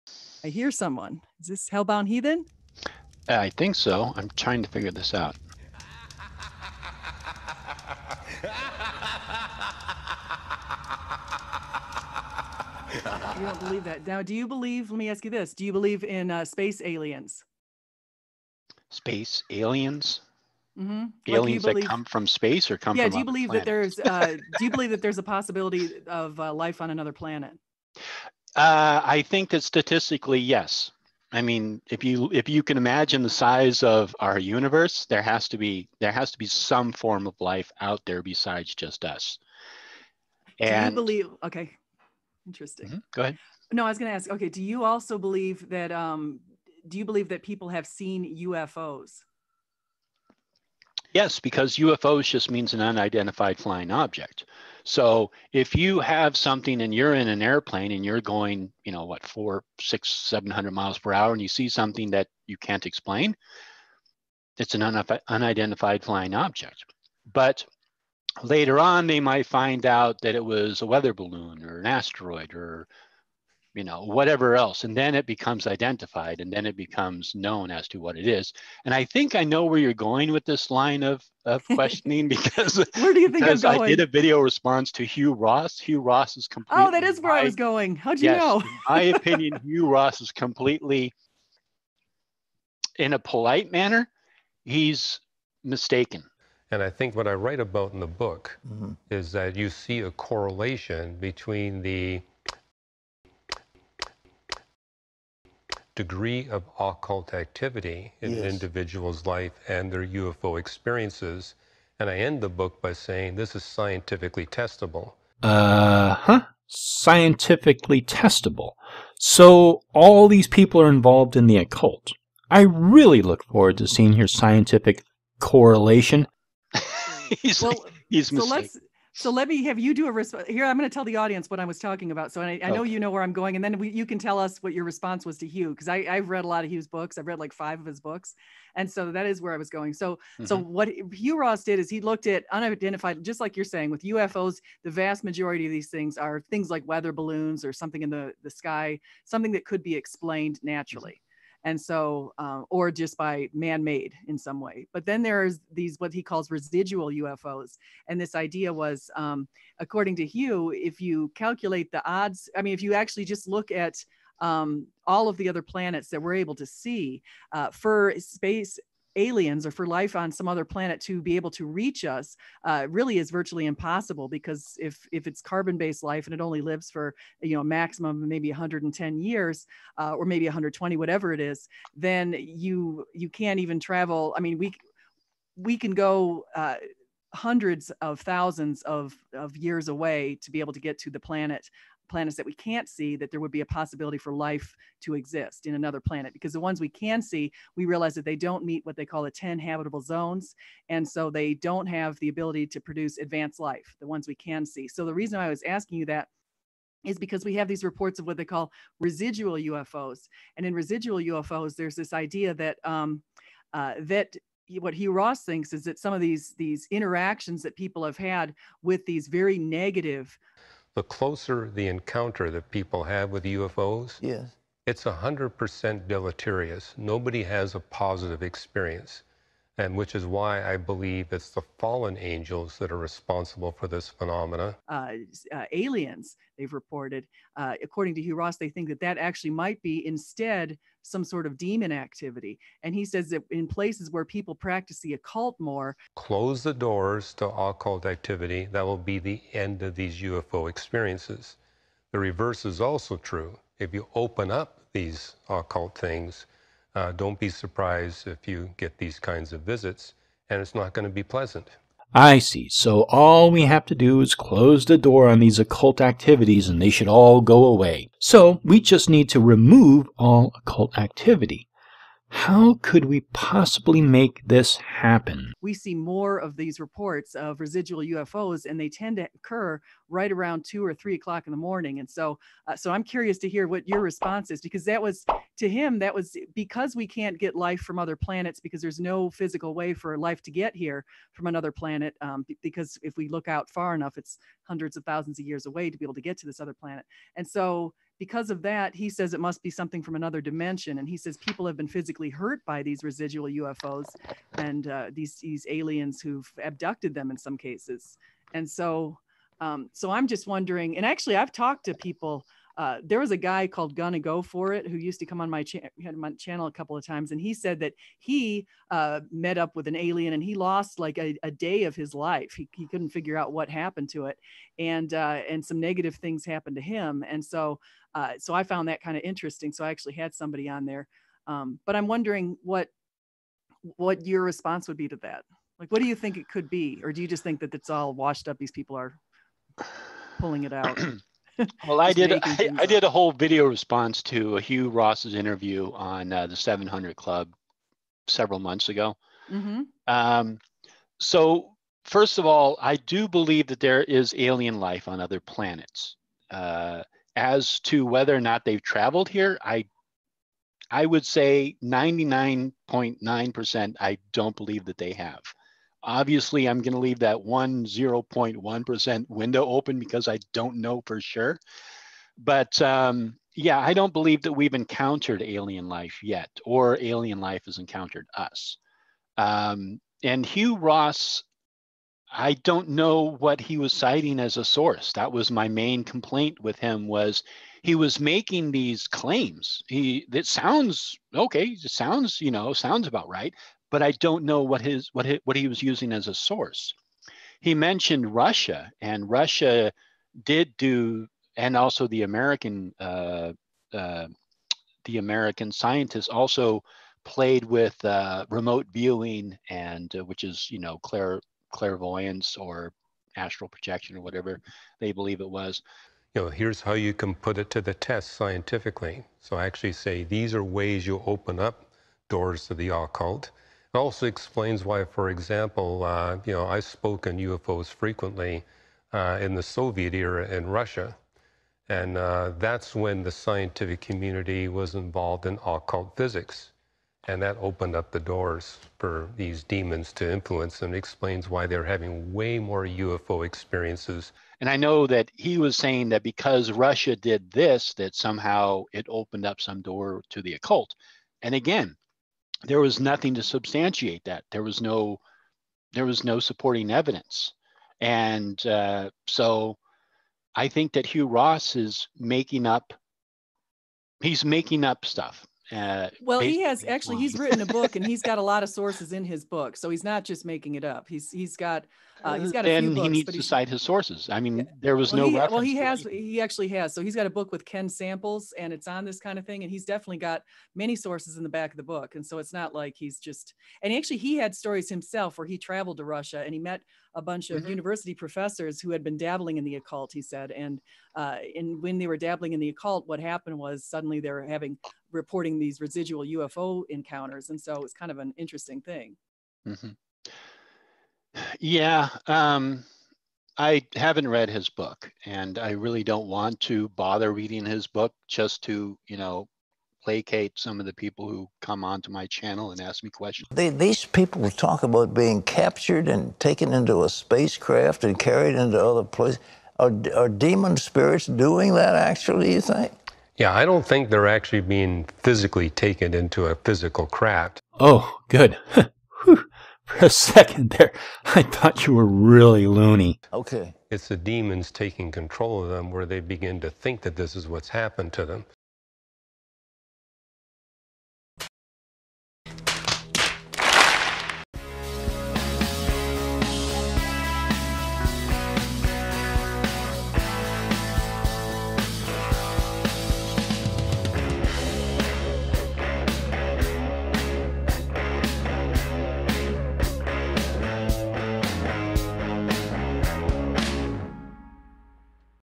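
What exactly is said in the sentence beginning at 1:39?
is that you see a correlation between the degree of occult activity in yes.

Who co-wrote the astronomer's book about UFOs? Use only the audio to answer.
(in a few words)
Ken Samples.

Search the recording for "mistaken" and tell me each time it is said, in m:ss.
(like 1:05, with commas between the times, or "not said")
1:35, 2:08.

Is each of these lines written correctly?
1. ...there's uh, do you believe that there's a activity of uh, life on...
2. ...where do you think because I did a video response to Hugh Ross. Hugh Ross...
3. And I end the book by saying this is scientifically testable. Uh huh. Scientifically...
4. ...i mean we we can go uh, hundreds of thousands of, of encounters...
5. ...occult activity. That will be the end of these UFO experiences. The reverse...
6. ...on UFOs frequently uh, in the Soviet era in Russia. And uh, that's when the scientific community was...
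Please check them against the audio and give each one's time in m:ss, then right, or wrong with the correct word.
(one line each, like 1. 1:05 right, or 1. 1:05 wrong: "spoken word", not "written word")
1. 0:23 wrong: "possibility", not "activity"
2. 1:22 right
3. 1:51 right
4. 3:04 wrong: "years", not "encounters"
5. 4:07 right
6. 7:07 right.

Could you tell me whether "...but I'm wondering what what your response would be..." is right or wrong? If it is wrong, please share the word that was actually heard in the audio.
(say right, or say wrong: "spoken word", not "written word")
right.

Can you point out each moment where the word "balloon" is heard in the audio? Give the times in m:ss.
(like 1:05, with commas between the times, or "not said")
1:11, 2:27.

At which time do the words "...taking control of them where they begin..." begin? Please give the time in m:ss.
8:54.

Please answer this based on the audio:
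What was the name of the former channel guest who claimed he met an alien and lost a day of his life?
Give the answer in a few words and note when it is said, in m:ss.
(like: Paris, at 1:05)
Gonna Go For It, at 5:13.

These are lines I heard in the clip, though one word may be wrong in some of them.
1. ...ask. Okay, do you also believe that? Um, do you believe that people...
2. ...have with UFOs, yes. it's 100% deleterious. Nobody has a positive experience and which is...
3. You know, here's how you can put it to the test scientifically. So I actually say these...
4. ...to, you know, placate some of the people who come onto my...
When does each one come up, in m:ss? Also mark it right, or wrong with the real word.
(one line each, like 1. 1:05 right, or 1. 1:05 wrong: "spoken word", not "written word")
1. 0:44 right
2. 3:43 right
3. 6:56 right
4. 8:28 right.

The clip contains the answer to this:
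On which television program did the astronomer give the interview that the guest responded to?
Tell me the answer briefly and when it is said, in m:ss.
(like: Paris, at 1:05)
The 700 Club, at 5:46.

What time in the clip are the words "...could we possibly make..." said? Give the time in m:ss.
4:32.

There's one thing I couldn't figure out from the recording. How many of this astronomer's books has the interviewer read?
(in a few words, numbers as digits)
5.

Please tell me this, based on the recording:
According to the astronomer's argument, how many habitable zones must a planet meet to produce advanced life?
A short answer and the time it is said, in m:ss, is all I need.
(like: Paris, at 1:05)
10, at 3:19.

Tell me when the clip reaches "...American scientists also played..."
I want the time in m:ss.
6:45.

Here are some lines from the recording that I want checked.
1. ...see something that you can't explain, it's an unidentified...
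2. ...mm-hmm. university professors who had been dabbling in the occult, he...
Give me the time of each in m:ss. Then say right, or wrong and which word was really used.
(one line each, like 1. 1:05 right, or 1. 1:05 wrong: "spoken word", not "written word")
1. 1:01 right
2. 8:07 right.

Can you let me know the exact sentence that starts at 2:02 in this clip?
I really look forward to seeing your scientific correlation.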